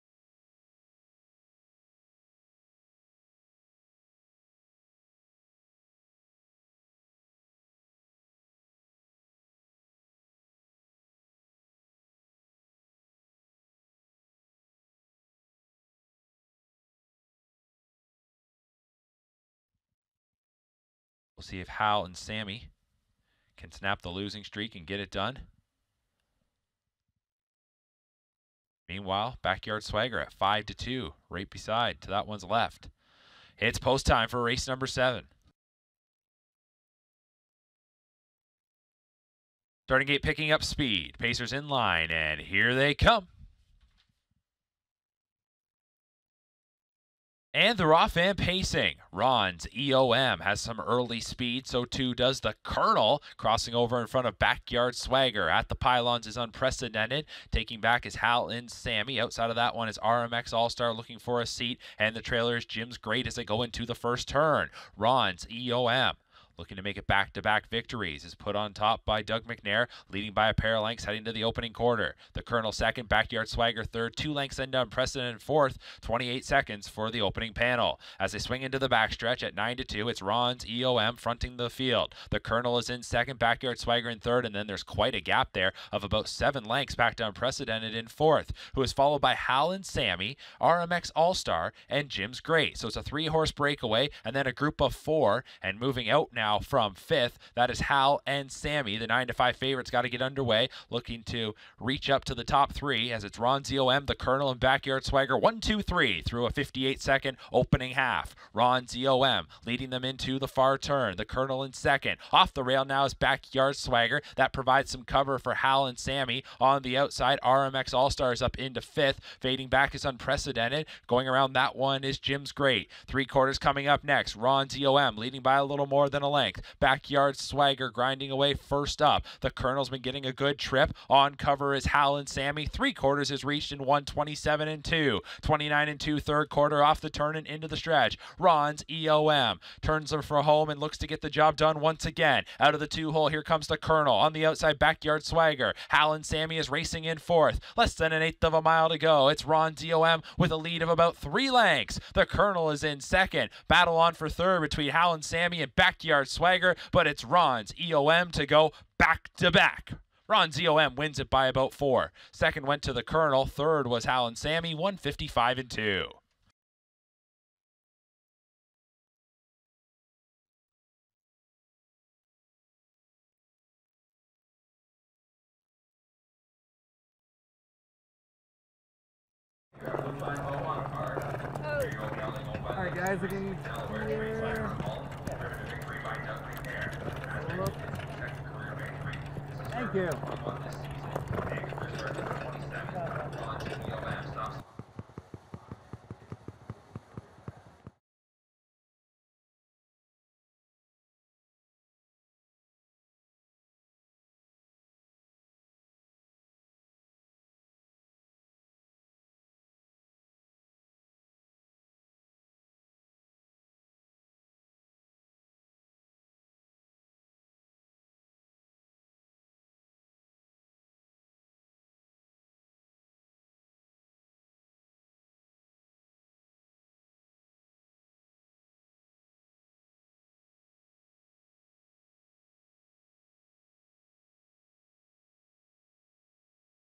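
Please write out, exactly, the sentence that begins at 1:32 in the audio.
So it's a three horse breakaway and then a group of four, and moving out now now from fifth.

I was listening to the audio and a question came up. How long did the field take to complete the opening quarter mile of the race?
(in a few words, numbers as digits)
28 seconds.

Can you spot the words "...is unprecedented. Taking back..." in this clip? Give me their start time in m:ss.
0:56.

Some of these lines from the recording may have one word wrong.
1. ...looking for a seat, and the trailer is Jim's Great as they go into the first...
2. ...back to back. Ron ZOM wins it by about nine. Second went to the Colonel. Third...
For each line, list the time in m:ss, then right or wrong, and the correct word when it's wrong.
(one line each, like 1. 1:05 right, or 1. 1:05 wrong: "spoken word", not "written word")
1. 1:00 right
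2. 2:38 wrong: "four", not "nine".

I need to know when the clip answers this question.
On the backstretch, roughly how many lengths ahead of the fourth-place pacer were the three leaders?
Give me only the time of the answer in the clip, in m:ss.
1:26.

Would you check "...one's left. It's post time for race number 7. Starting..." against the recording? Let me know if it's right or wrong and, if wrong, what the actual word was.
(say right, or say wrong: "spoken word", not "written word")
right.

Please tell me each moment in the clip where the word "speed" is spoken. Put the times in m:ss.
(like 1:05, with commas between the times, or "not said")
0:40, 0:51.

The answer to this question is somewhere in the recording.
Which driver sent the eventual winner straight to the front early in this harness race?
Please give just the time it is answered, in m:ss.
1:09.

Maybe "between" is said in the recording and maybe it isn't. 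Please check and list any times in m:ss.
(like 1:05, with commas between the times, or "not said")
2:34.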